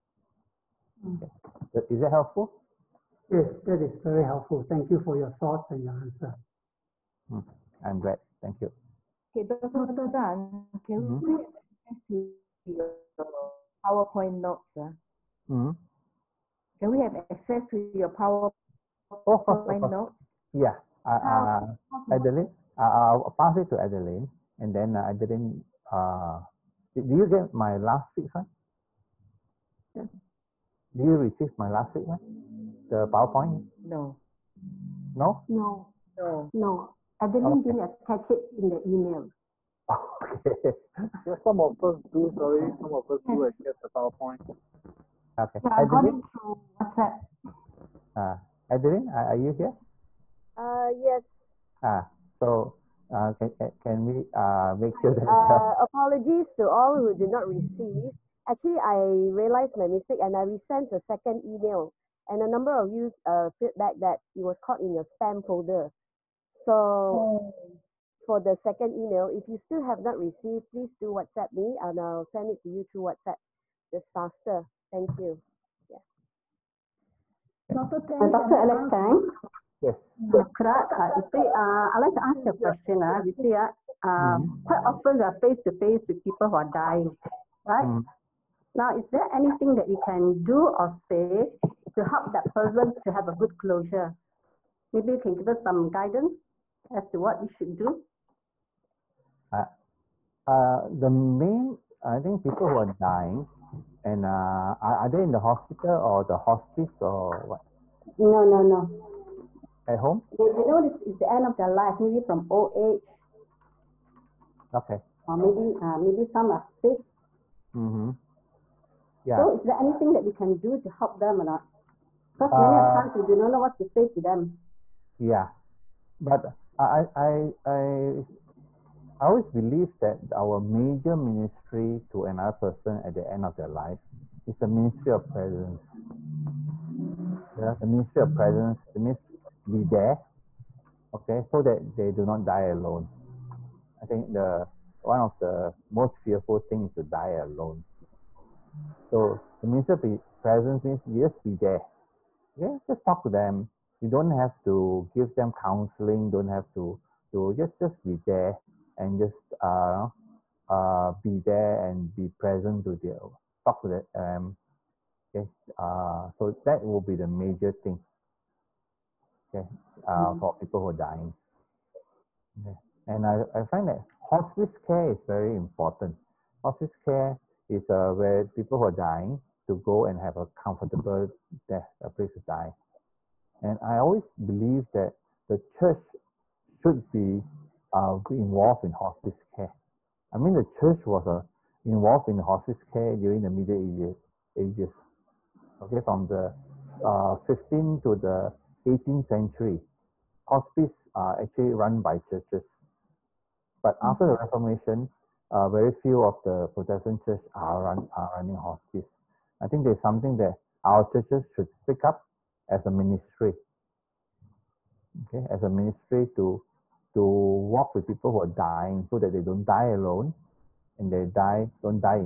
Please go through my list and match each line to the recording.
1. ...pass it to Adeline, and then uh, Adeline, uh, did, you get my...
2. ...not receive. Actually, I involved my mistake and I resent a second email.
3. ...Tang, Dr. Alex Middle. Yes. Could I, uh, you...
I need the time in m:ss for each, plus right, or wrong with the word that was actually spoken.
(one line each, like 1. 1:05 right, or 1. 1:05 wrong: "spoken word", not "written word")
1. 0:23 right
2. 0:57 wrong: "realized", not "involved"
3. 1:18 wrong: "Tang", not "Middle".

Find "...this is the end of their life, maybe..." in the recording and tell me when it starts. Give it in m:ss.
1:50.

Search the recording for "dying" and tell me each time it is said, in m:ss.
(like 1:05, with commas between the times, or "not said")
1:26, 1:42, 2:51, 2:58, 3:38.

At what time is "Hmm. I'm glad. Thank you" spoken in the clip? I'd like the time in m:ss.
0:07.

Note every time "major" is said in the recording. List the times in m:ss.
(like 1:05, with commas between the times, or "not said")
2:10, 2:47.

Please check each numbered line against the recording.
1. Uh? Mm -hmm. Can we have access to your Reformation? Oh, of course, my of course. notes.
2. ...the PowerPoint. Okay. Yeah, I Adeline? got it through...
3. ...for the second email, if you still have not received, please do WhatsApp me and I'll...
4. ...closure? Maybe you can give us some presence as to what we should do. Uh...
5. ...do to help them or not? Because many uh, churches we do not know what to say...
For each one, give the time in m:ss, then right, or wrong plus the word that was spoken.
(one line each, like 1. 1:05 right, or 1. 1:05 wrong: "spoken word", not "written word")
1. 0:14 wrong: "PowerPoint", not "Reformation"
2. 0:43 right
3. 1:08 right
4. 1:33 wrong: "guidance", not "presence"
5. 2:00 wrong: "times", not "churches".